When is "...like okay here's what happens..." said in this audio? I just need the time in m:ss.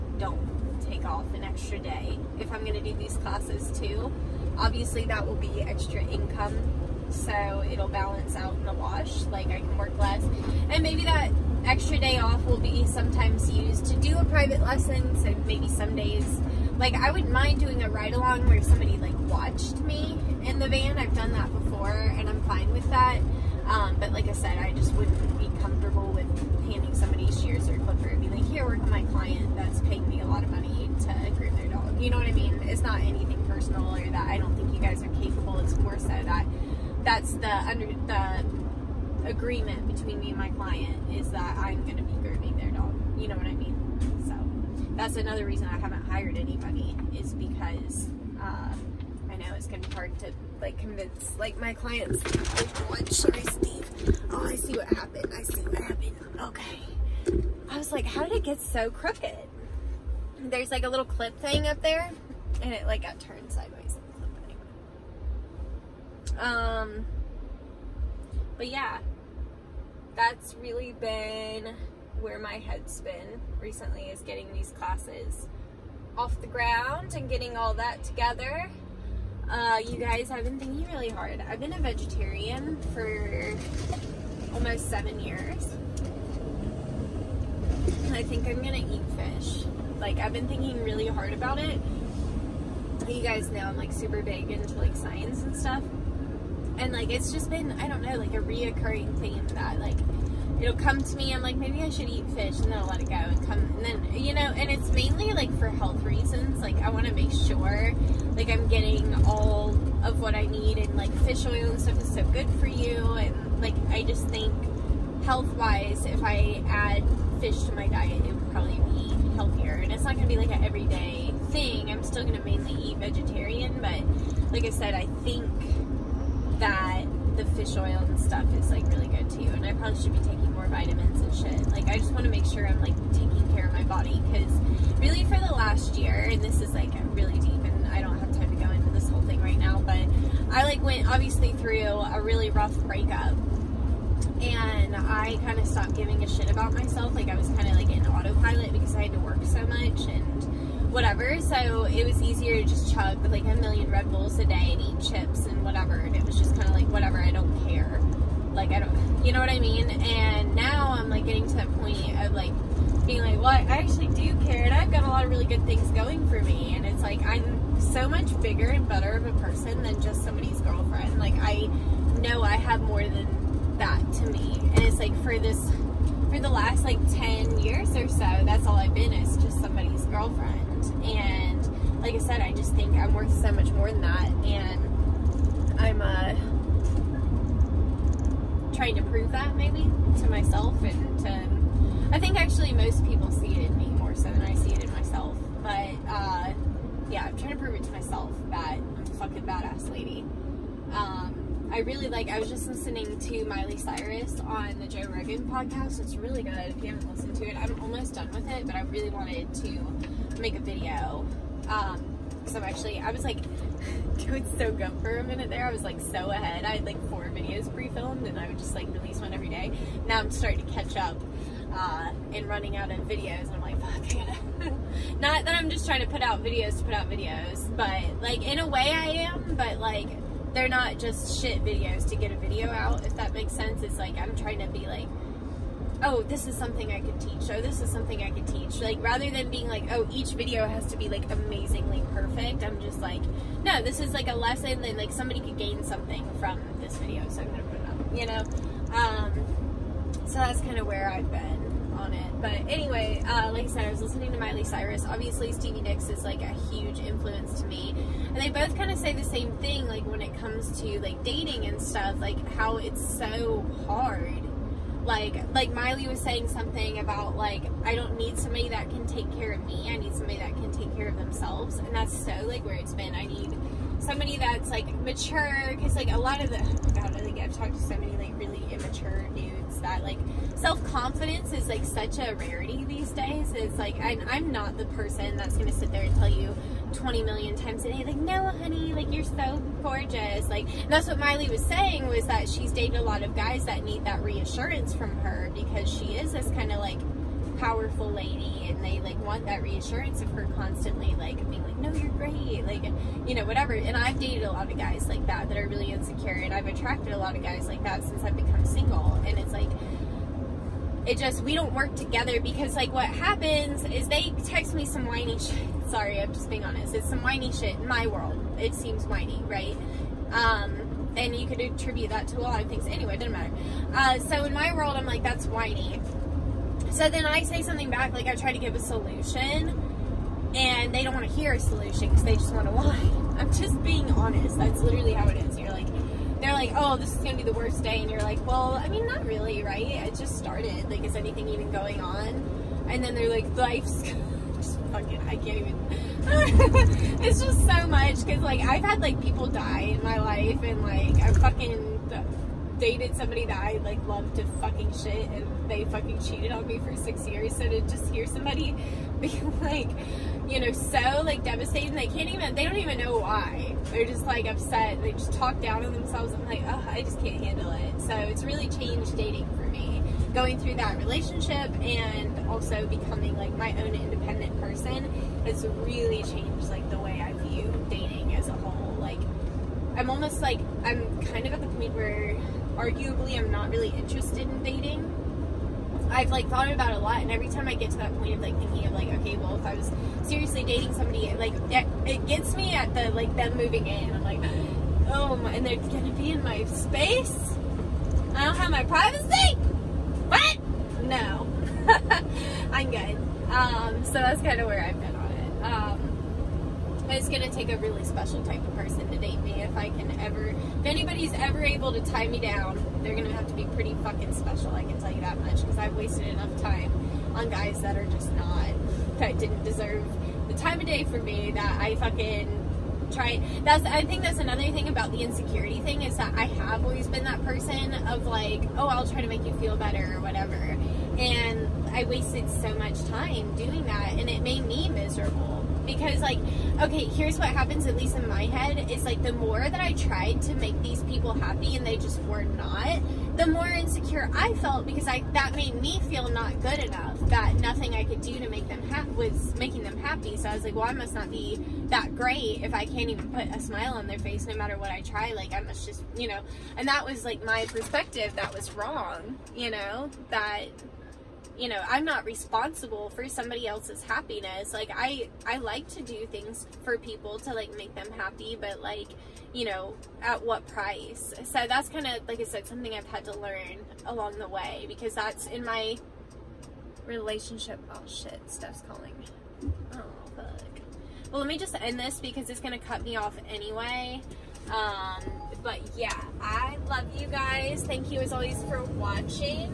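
7:16.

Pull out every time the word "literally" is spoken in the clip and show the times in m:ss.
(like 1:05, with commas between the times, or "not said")
5:34.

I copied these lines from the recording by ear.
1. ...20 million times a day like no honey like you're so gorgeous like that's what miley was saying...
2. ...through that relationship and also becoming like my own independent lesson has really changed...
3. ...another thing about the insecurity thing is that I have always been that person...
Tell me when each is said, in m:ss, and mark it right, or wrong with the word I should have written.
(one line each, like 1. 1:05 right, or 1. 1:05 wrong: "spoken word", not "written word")
1. 4:46 right
2. 6:10 wrong: "person", not "lesson"
3. 7:04 right.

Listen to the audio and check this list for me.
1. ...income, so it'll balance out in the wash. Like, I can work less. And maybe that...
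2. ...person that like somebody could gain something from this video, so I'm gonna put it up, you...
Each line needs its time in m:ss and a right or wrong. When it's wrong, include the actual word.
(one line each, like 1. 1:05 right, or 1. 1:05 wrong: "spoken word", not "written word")
1. 0:06 right
2. 4:04 wrong: "lesson", not "person".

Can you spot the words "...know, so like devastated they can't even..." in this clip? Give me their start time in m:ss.
6:00.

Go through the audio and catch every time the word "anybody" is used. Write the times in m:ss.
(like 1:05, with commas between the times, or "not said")
0:46, 6:50.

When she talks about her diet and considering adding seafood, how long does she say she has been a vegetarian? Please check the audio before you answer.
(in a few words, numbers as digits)
almost 7 years.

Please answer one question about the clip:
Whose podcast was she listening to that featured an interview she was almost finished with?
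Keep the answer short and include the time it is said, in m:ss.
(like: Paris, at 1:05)
Joe Rogan, at 3:24.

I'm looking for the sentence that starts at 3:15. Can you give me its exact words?
But uh, yeah, I'm trying to prove it to myself that I'm a fucking badass lady.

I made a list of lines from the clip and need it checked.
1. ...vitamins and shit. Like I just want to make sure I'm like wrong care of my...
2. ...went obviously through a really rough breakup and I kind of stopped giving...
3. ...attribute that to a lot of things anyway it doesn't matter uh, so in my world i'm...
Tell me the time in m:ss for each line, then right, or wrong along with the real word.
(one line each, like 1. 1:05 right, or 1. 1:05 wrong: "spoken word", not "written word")
1. 2:10 wrong: "taking", not "wrong"
2. 2:20 right
3. 5:21 right.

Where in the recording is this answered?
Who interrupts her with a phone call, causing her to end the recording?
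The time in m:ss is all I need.
7:58.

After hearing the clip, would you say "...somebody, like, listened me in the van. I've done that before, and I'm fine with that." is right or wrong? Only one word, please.
wrong.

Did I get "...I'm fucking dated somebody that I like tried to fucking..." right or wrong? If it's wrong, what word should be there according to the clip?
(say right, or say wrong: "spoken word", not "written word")
wrong: "loved", not "tried".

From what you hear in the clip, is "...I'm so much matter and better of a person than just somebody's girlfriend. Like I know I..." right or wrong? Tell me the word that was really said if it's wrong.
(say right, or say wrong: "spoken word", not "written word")
wrong: "bigger", not "matter".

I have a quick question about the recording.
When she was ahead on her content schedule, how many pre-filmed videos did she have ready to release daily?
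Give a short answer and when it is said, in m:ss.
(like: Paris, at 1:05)
4, at 3:37.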